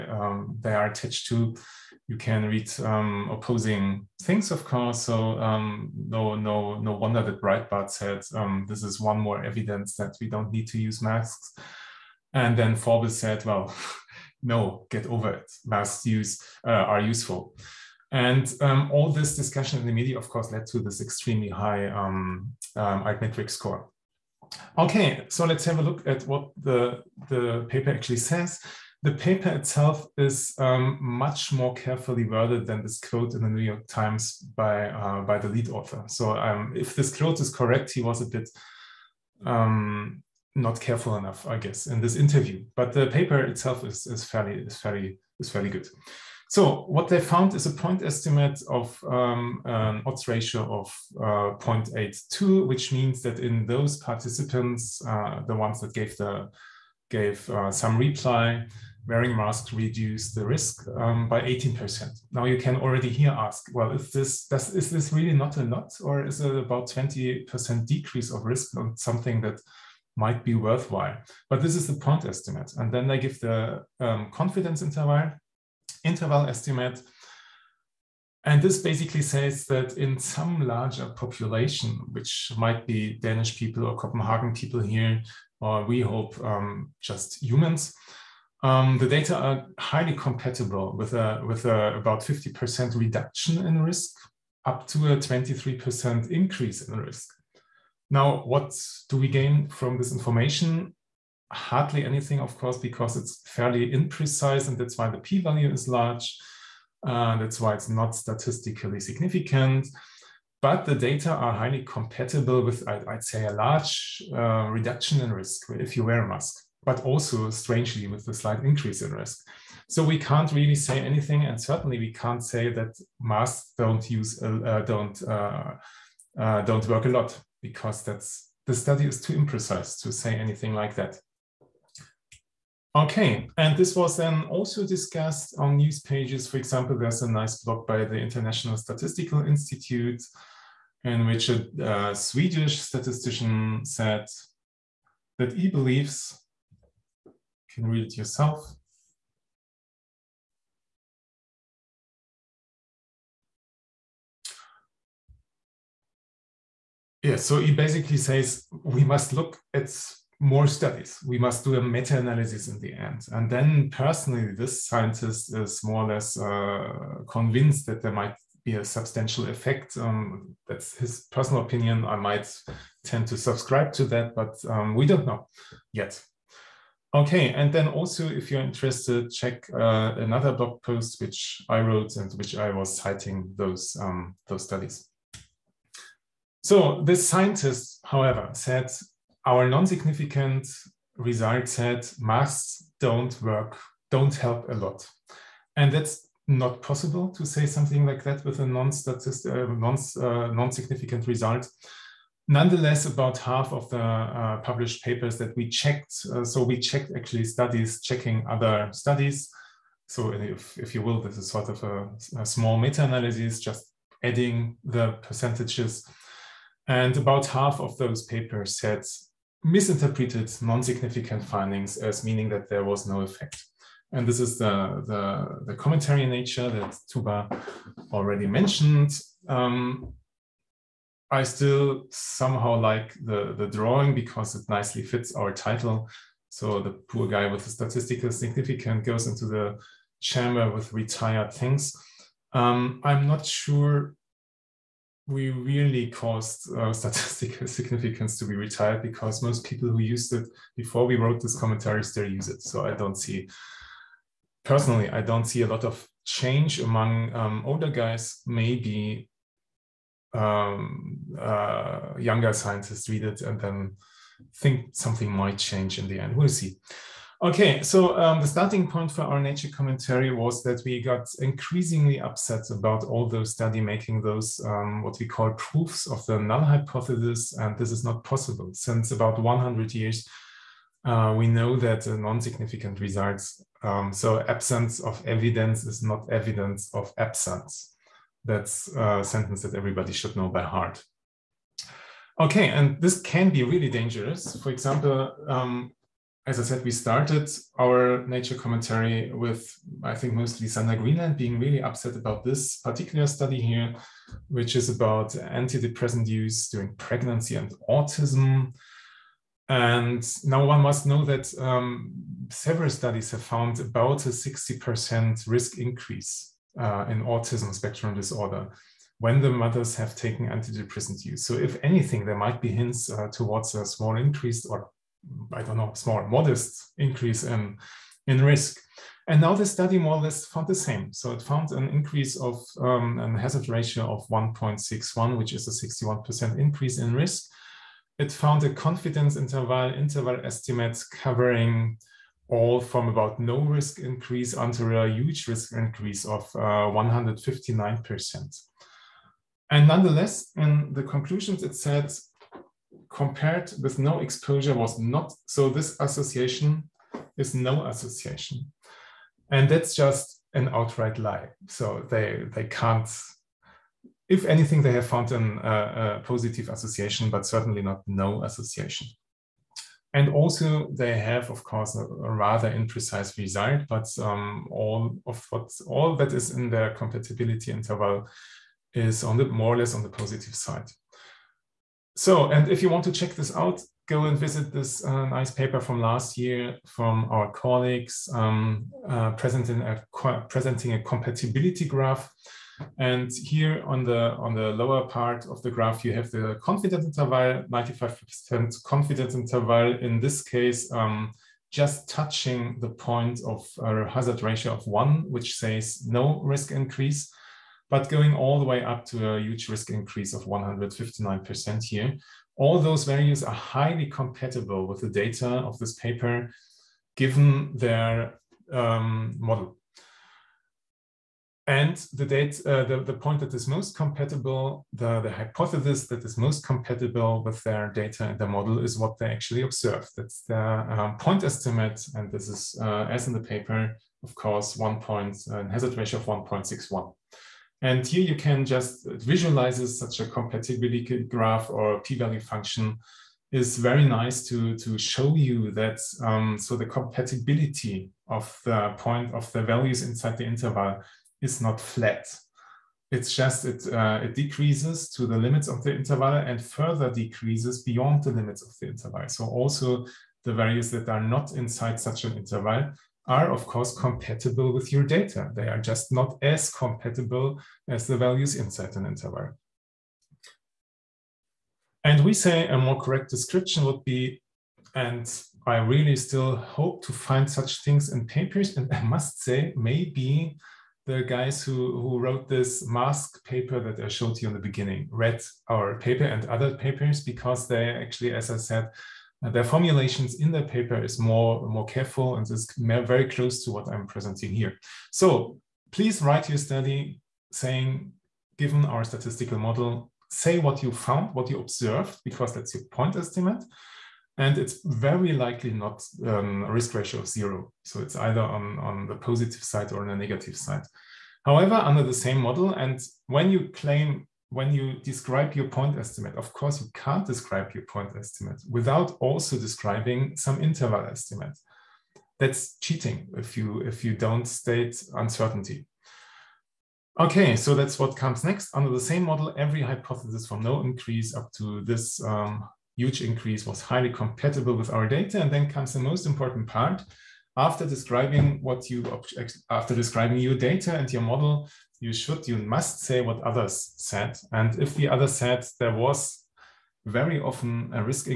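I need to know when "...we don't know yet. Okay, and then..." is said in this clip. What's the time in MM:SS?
02:54.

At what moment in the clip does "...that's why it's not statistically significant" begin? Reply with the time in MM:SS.
01:47.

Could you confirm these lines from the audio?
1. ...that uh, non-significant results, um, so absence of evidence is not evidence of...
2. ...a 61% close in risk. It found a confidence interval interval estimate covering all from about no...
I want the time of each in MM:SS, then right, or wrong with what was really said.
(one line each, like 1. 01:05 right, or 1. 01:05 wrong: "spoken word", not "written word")
1. 04:41 right
2. 05:35 wrong: "increase", not "close".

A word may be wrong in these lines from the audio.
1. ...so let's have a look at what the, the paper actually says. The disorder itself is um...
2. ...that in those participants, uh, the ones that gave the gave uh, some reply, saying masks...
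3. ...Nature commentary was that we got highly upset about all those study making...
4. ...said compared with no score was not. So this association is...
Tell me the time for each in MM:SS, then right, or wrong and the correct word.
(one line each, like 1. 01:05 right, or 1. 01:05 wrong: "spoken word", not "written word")
1. 00:25 wrong: "paper", not "disorder"
2. 00:53 wrong: "wearing", not "saying"
3. 04:29 wrong: "increasingly", not "highly"
4. 05:51 wrong: "exposure", not "score".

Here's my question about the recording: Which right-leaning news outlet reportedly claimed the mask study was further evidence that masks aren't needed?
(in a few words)
Breitbart.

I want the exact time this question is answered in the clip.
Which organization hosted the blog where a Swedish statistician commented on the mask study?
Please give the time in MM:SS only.
02:18.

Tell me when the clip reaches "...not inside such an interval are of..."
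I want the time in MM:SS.
07:41.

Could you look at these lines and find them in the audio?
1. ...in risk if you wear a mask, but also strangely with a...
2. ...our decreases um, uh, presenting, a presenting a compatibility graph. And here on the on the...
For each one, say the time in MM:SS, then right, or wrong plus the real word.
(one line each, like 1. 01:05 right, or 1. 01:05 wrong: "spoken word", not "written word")
1. 01:55 right
2. 06:27 wrong: "colleagues", not "decreases".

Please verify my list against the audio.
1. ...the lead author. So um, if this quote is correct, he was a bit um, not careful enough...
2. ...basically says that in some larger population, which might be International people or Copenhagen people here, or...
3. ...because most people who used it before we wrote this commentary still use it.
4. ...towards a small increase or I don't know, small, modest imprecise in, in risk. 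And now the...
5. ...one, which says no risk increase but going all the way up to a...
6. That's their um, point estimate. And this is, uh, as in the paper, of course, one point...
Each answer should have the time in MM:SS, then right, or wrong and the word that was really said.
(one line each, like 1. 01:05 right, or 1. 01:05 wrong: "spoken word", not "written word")
1. 00:35 right
2. 01:18 wrong: "Danish", not "International"
3. 04:09 right
4. 05:23 wrong: "increase", not "imprecise"
5. 06:44 right
6. 07:10 right.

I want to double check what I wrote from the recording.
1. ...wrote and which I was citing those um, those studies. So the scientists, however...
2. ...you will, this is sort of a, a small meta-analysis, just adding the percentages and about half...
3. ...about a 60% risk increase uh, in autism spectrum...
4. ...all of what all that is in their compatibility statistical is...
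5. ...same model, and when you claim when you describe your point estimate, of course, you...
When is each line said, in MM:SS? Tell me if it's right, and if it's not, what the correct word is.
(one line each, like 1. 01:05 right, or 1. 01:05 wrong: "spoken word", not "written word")
1. 03:01 right
2. 03:30 right
3. 05:13 right
4. 06:14 wrong: "interval", not "statistical"
5. 08:32 right.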